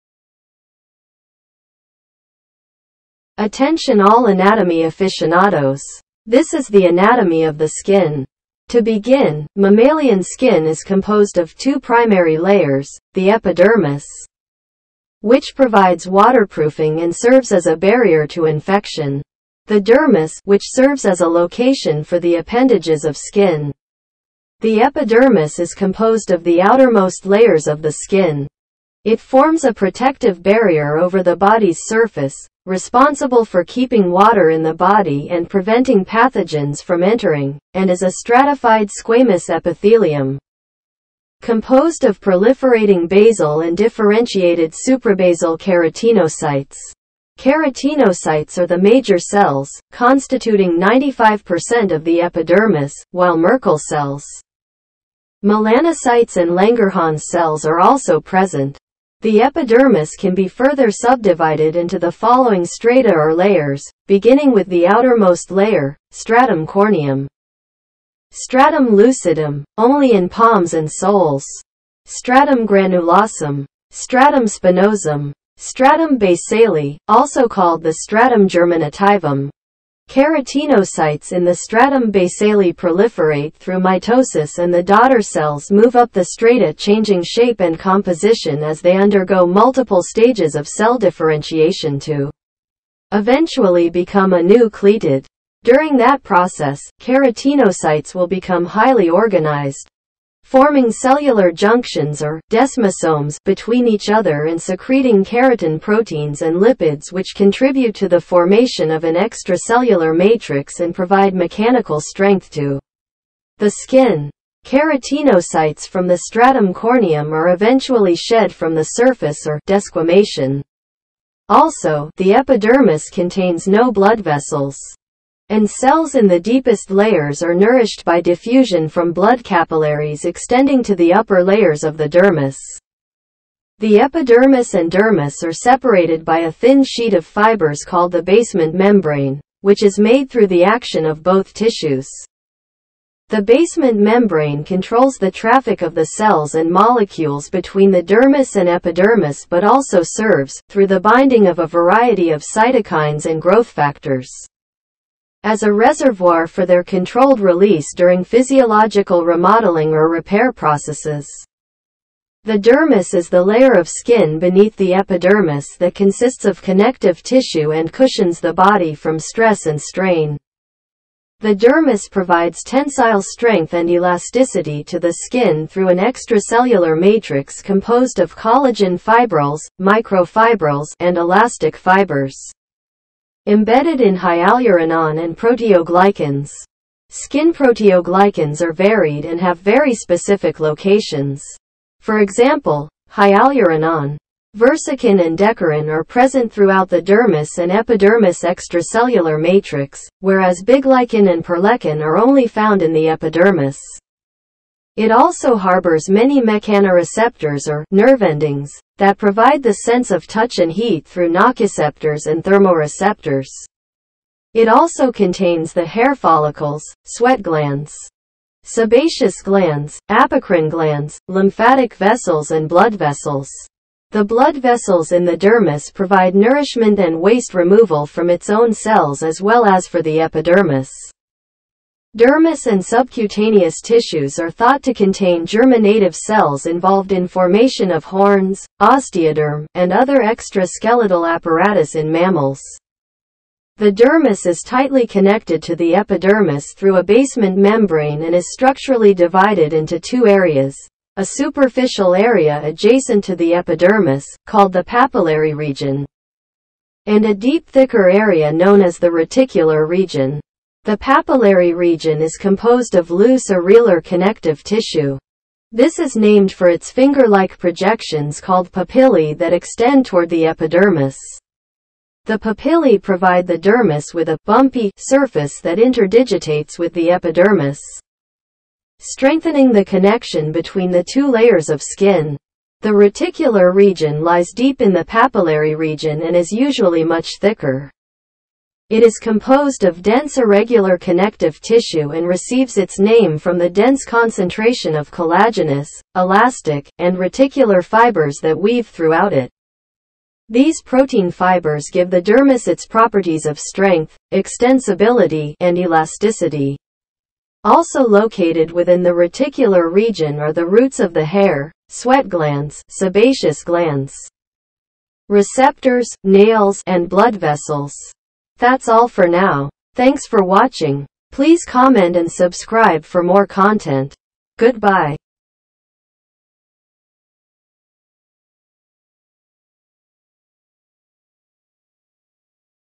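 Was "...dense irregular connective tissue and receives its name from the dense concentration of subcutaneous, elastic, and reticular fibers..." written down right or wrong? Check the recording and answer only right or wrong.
wrong.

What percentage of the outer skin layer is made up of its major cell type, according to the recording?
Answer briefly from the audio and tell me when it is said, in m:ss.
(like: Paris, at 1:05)
95%, at 0:50.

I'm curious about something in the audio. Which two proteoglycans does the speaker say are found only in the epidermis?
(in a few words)
Biglycan and perlecan.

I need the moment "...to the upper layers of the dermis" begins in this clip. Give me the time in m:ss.
2:10.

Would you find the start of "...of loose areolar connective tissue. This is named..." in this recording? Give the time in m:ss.
4:22.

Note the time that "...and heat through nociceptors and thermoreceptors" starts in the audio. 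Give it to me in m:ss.
3:30.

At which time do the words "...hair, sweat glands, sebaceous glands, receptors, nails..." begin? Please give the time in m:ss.
5:11.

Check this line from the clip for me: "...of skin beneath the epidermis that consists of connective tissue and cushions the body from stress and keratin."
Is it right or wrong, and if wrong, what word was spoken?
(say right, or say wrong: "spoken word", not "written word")
wrong: "strain", not "keratin".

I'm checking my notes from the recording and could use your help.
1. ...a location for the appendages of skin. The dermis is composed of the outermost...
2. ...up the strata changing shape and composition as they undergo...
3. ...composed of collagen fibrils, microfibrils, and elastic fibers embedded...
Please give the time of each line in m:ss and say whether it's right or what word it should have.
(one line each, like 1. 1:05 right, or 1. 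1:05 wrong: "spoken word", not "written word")
1. 0:21 wrong: "epidermis", not "dermis"
2. 1:25 right
3. 2:57 right.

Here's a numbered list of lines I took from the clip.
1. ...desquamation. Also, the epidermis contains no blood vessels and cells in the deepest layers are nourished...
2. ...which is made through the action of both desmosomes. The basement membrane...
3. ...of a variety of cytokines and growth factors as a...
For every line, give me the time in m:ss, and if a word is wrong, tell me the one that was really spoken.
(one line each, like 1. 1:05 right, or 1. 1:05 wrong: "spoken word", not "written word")
1. 1:59 right
2. 2:19 wrong: "tissues", not "desmosomes"
3. 2:31 right.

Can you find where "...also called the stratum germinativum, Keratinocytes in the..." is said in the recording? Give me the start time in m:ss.
1:17.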